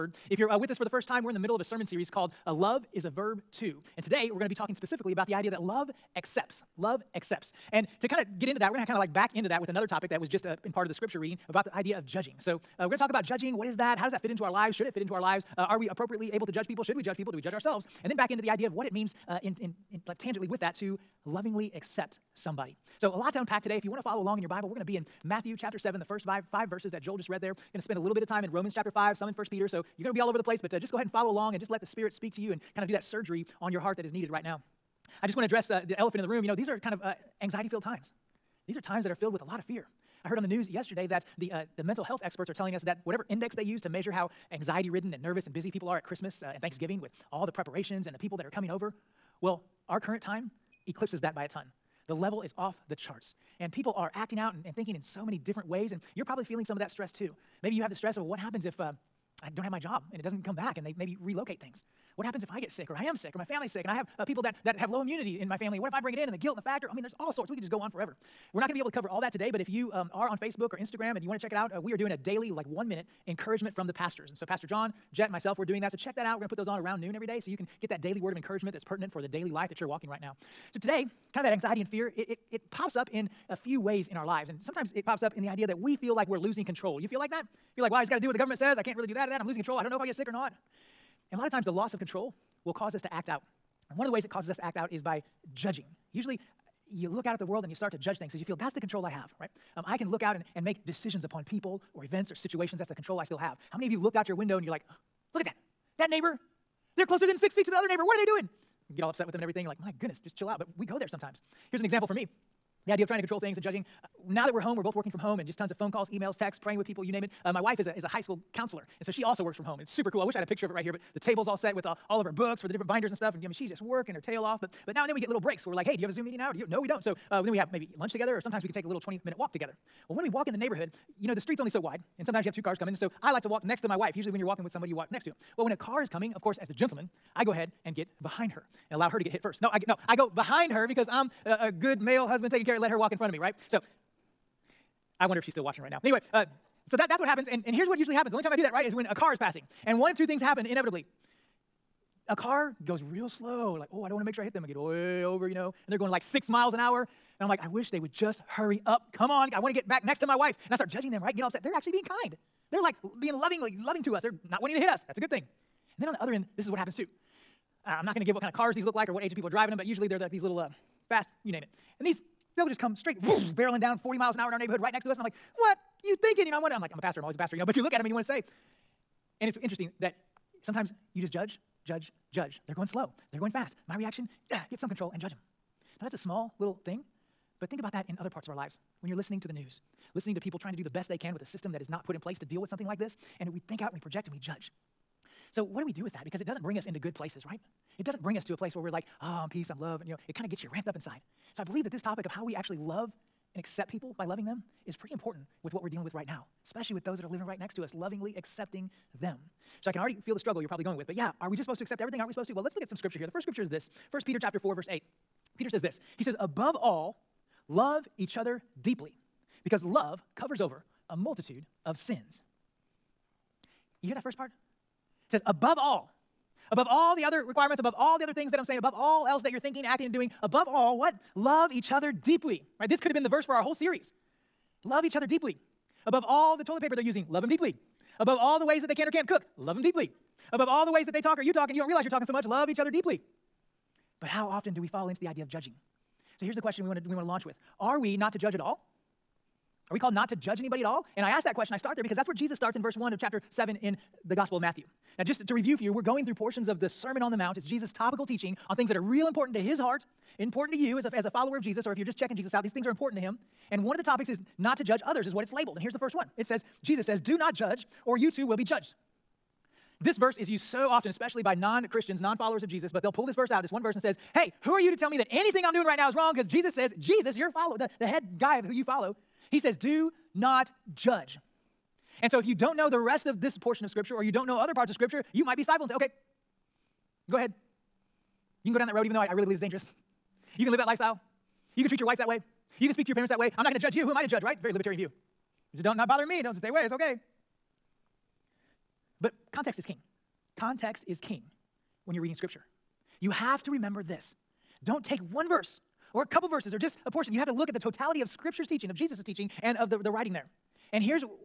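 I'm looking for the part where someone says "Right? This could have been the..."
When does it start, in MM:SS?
03:52.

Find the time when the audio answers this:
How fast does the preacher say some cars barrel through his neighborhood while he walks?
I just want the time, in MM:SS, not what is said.
02:54.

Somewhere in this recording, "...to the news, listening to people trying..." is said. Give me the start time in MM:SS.
03:09.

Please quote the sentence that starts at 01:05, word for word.
What if I bring it in and the guilt and the factor?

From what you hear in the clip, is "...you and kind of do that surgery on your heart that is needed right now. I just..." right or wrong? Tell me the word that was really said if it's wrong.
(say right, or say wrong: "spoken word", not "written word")
right.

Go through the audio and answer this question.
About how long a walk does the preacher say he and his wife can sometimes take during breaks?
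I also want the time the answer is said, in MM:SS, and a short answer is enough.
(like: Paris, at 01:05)
20 minutes, at 02:08.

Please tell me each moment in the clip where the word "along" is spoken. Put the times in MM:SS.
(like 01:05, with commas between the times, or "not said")
00:24, 00:31.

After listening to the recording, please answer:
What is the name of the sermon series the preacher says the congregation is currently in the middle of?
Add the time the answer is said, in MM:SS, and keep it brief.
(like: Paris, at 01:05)
Love is a Verb Too, at 00:02.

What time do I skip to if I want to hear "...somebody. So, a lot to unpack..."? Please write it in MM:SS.
00:22.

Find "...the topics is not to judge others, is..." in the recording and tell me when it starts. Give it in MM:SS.
04:23.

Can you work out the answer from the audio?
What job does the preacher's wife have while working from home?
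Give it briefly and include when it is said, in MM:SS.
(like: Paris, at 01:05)
High school counselor, at 01:58.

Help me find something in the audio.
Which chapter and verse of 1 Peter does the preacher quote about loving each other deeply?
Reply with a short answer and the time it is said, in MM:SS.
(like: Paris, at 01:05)
Chapter 4, verse 8, at 03:34.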